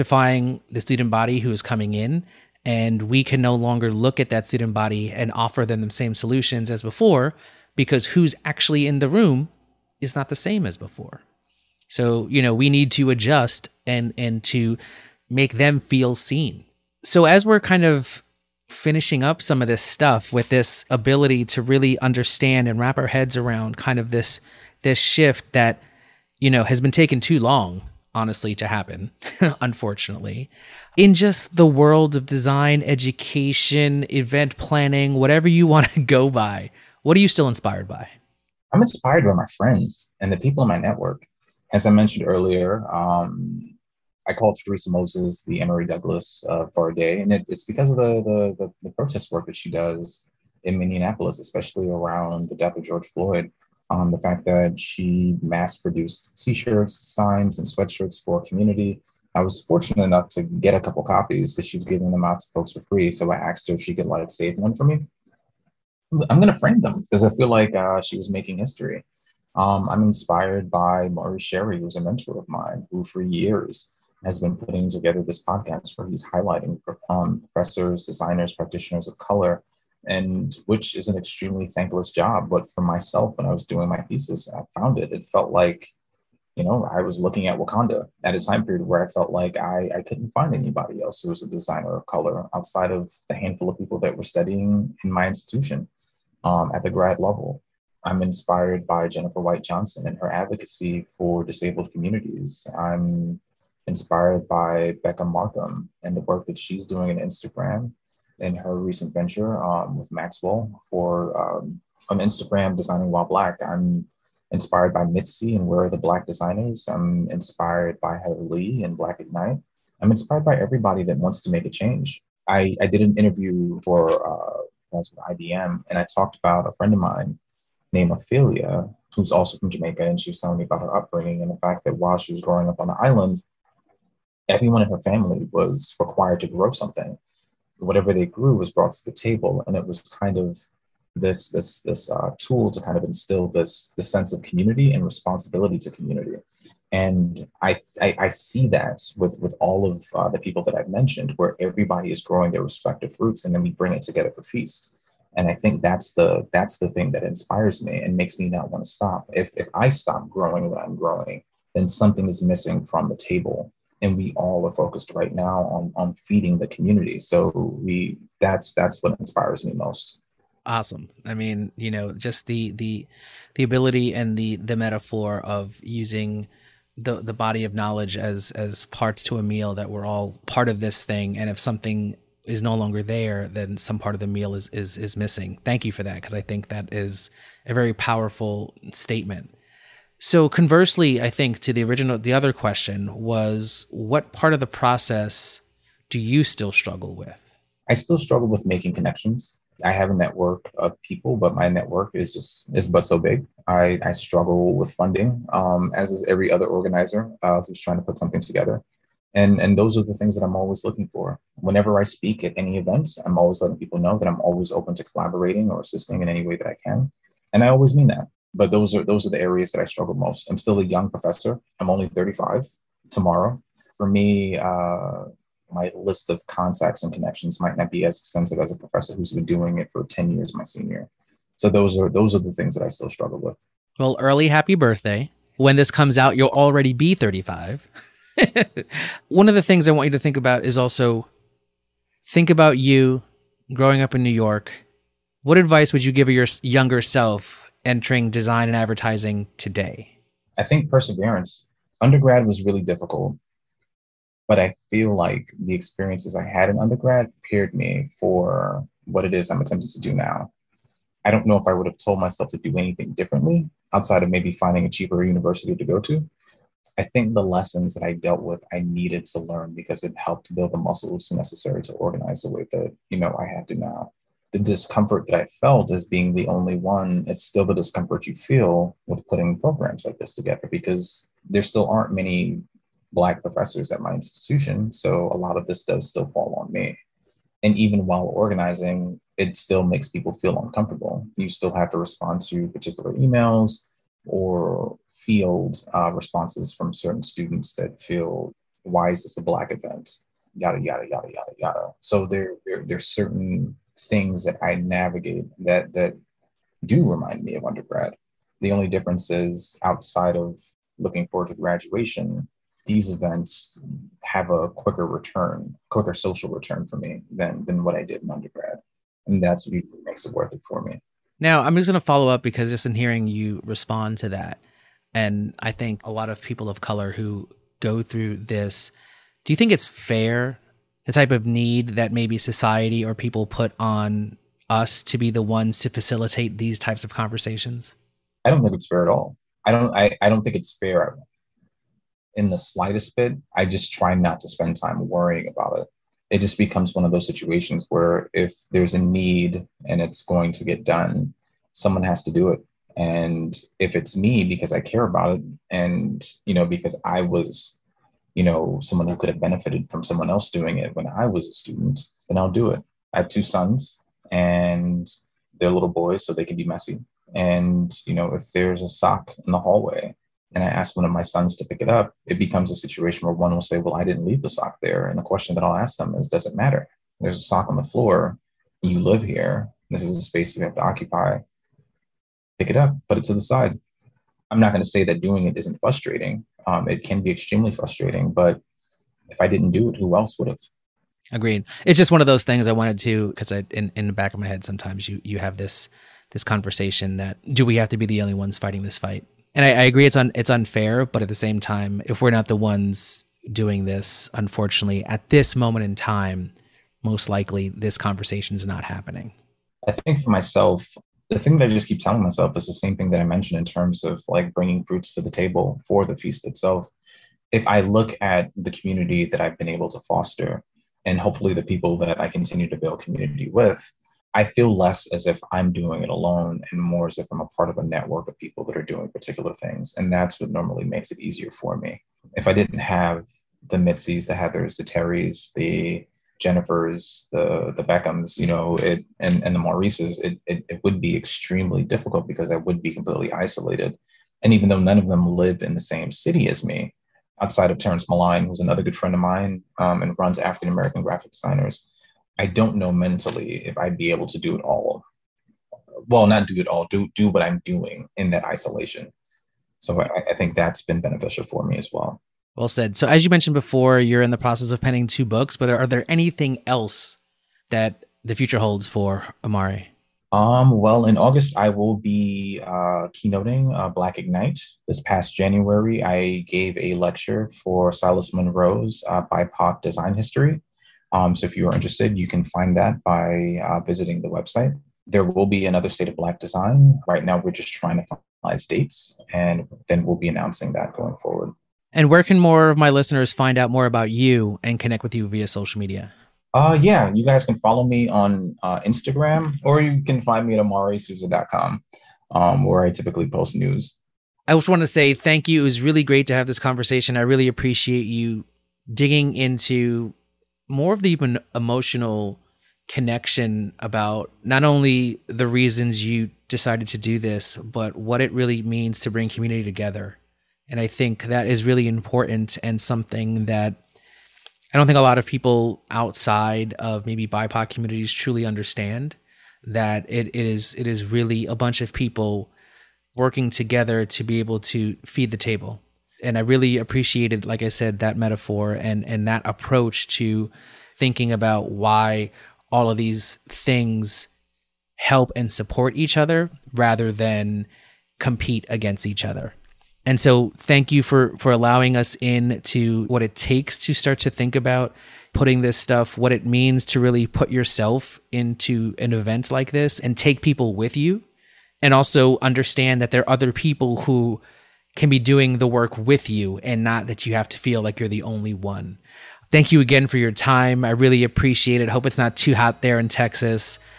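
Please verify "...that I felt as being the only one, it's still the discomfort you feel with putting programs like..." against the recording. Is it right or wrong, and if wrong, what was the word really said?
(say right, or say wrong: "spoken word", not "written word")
right.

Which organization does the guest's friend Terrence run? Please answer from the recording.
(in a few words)
African American Graphic Designers.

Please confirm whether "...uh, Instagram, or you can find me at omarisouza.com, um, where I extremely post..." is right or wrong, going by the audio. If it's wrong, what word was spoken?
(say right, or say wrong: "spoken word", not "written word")
wrong: "typically", not "extremely".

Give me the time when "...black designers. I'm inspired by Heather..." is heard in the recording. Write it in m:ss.
1:55.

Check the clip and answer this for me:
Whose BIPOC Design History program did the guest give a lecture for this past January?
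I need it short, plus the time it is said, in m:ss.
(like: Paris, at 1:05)
Silas Munro, at 7:57.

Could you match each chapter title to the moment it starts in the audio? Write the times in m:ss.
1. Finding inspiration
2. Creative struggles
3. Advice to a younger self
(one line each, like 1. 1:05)
1. 0:29
2. 3:09
3. 4:01.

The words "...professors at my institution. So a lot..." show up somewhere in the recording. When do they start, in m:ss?
4:43.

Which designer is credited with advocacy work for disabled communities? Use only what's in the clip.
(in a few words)
Jennifer White Johnson.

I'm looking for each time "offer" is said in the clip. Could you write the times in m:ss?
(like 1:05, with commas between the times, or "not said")
0:05.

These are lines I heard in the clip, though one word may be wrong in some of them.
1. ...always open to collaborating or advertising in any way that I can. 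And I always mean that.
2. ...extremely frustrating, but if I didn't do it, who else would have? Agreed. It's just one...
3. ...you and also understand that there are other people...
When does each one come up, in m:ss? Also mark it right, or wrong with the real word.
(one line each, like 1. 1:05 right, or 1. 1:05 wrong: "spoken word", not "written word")
1. 3:34 wrong: "assisting", not "advertising"
2. 6:27 right
3. 9:20 right.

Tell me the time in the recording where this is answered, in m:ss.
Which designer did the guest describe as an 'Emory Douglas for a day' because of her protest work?
0:44.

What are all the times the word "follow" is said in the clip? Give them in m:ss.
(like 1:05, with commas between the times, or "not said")
5:22, 8:17.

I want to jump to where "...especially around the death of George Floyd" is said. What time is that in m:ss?
0:51.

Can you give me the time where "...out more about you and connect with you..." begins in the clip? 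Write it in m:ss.
8:13.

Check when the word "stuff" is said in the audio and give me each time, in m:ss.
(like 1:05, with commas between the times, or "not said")
0:19, 9:15.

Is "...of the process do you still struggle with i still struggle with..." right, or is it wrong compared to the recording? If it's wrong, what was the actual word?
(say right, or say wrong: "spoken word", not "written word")
right.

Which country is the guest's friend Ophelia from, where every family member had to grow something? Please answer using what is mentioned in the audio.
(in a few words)
Jamaica.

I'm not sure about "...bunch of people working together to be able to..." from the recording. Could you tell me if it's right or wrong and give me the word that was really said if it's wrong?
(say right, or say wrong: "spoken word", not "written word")
right.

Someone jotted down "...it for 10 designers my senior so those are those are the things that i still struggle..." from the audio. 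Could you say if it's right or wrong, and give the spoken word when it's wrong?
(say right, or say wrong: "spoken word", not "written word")
wrong: "years", not "designers".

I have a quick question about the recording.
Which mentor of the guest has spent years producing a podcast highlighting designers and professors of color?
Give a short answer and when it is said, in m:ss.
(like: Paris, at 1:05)
Maurice Cherry, at 1:11.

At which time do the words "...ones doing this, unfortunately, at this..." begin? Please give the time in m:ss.
6:42.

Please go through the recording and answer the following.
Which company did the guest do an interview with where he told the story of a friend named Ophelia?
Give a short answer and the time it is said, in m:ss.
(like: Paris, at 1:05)
IBM, at 2:05.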